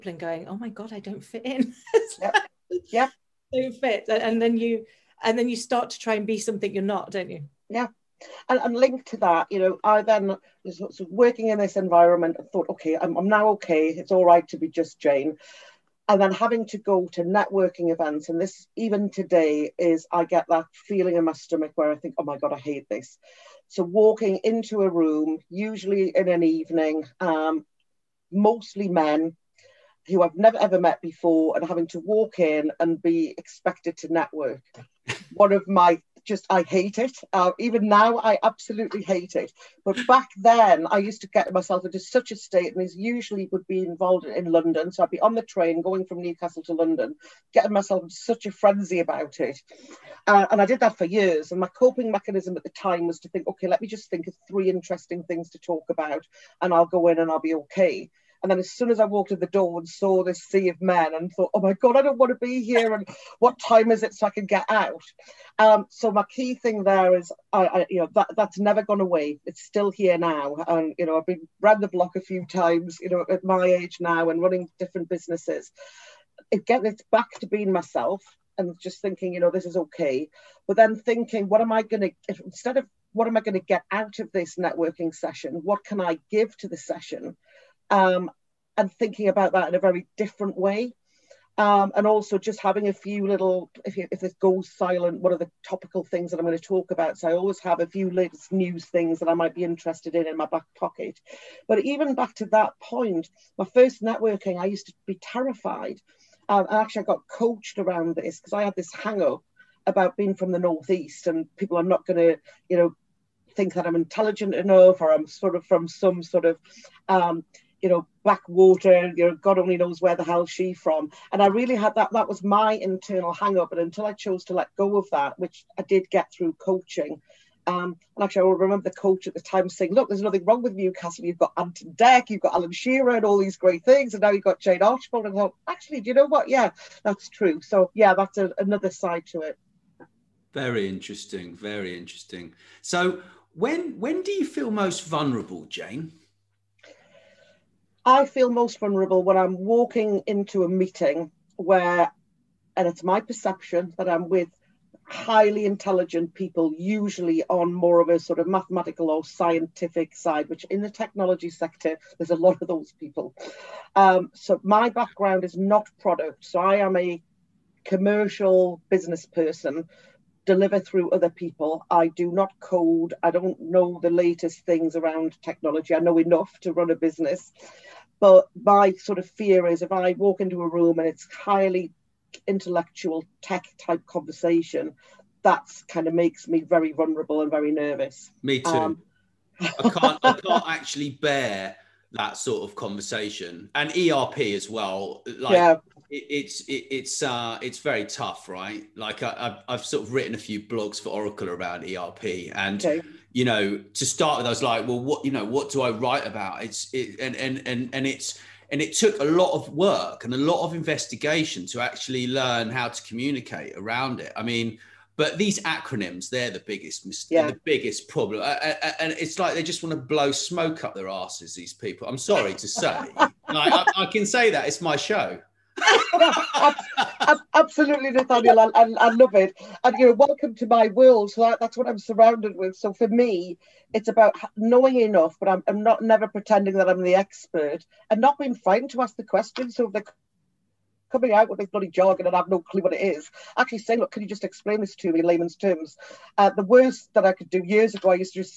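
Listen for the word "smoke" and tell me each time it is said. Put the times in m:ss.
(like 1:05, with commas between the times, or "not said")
3:40.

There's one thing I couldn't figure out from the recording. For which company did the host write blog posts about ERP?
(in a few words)
Oracle.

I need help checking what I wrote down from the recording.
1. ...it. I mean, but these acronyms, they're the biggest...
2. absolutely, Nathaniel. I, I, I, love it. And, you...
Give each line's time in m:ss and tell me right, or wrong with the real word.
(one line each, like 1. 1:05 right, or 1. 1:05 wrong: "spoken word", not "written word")
1. 3:34 right
2. 3:47 right.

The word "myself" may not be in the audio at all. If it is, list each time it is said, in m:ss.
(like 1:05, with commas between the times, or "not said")
0:41, 0:47, 1:17.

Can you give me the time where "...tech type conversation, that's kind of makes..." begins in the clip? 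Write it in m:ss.
3:03.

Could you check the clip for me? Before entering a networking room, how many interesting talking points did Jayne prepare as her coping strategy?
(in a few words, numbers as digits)
3.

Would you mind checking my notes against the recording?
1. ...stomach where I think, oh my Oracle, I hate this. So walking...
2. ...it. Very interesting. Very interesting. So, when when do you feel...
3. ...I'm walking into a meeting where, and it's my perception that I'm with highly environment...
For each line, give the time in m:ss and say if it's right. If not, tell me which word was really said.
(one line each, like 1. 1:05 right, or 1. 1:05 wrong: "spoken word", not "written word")
1. 0:21 wrong: "God", not "Oracle"
2. 2:19 right
3. 2:29 wrong: "intelligent", not "environment".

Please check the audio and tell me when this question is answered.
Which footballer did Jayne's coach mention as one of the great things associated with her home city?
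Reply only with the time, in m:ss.
2:12.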